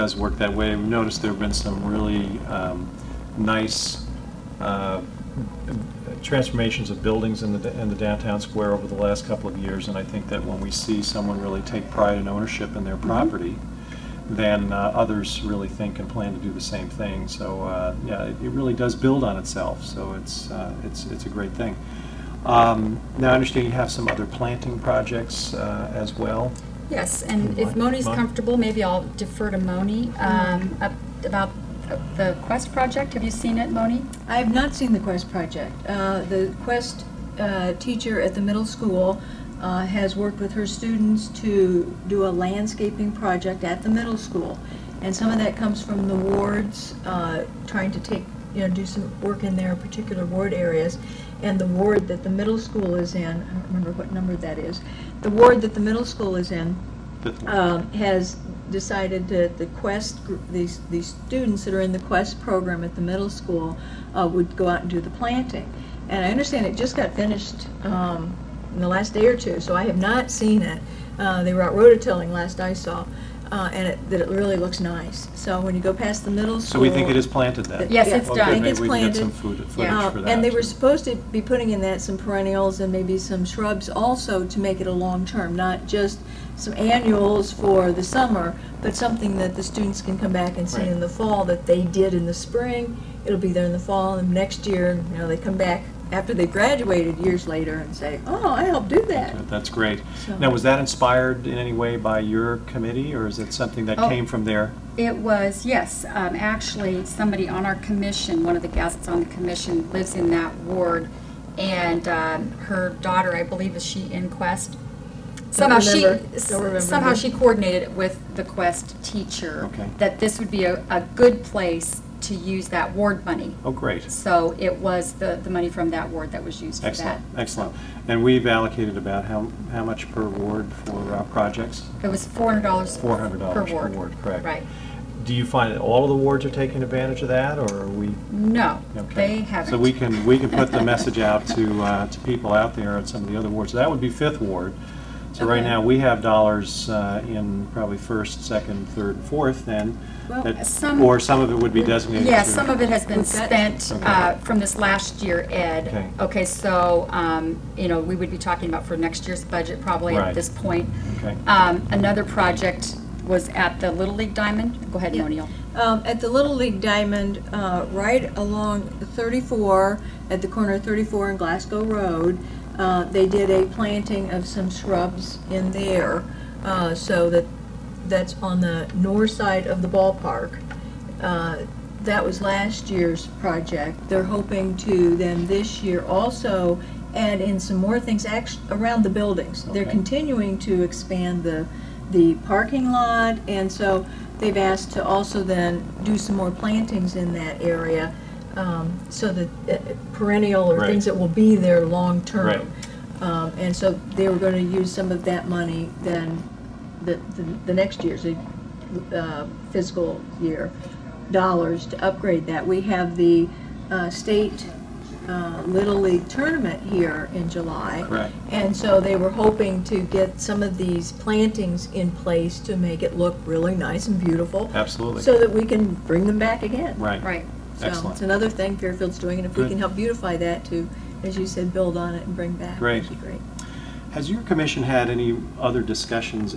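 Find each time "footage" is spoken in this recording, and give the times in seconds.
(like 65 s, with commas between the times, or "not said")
79 s.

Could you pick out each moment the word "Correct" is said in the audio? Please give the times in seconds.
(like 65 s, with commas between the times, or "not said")
134 s, 218 s.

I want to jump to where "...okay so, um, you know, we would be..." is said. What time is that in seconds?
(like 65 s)
156 s.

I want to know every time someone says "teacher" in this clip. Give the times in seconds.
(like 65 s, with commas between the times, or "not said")
37 s, 119 s.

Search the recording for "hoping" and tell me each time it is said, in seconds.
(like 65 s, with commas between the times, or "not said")
184 s, 219 s.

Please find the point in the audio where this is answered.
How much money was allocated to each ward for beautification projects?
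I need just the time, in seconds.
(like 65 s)
132 s.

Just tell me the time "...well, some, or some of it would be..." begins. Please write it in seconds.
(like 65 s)
150 s.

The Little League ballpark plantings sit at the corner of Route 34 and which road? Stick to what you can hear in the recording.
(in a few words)
Glasgow Road.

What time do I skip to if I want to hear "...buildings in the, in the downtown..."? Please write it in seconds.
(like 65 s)
7 s.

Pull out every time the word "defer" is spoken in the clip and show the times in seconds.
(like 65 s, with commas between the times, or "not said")
29 s.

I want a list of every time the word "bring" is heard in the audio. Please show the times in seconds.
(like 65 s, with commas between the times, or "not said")
226 s, 232 s.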